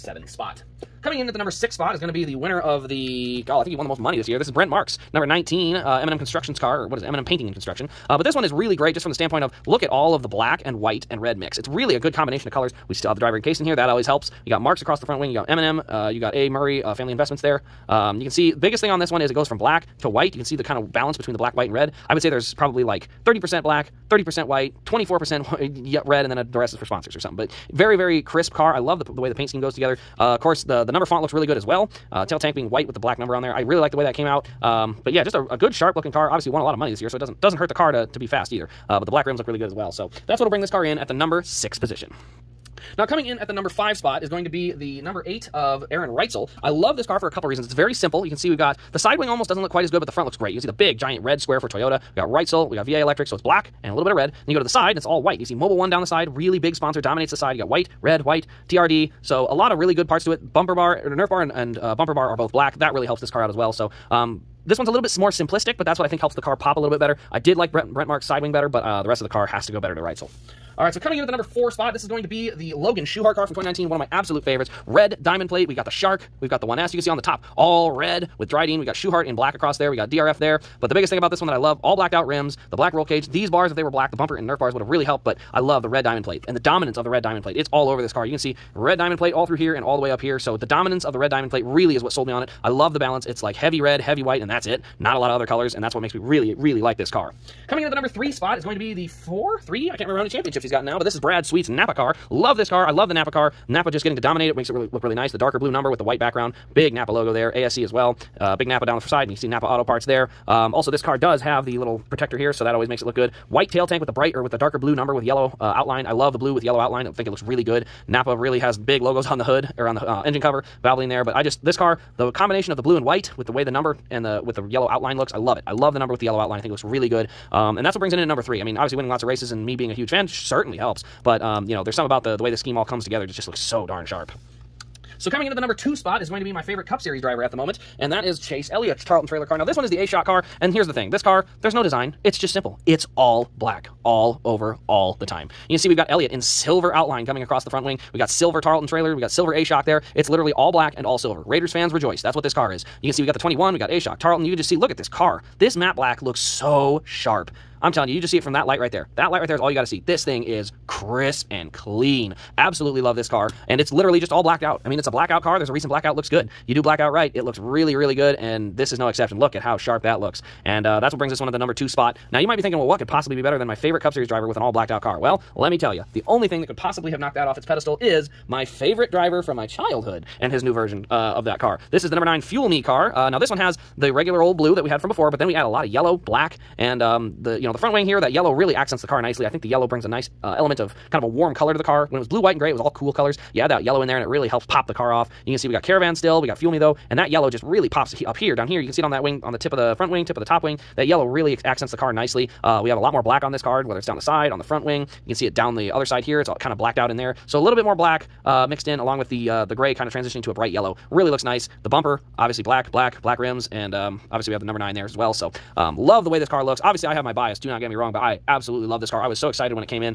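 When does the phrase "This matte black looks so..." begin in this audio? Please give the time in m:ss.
2:35.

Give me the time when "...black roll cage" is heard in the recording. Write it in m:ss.
1:22.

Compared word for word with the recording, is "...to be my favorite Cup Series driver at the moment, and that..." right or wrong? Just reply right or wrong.
right.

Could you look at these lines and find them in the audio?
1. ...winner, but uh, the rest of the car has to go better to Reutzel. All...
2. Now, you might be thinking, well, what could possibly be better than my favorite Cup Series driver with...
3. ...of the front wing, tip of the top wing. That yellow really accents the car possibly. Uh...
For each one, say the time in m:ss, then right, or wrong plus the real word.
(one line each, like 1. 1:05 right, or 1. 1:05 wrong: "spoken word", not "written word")
1. 1:08 wrong: "better", not "winner"
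2. 2:52 right
3. 3:19 wrong: "nicely", not "possibly".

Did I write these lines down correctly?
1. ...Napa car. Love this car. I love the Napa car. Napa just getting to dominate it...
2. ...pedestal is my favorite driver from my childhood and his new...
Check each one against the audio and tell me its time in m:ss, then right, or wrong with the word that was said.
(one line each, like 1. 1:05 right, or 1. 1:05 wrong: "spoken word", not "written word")
1. 1:41 right
2. 2:57 right.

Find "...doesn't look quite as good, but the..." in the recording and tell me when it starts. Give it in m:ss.
0:49.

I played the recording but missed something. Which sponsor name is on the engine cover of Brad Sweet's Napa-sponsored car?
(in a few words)
Valvoline.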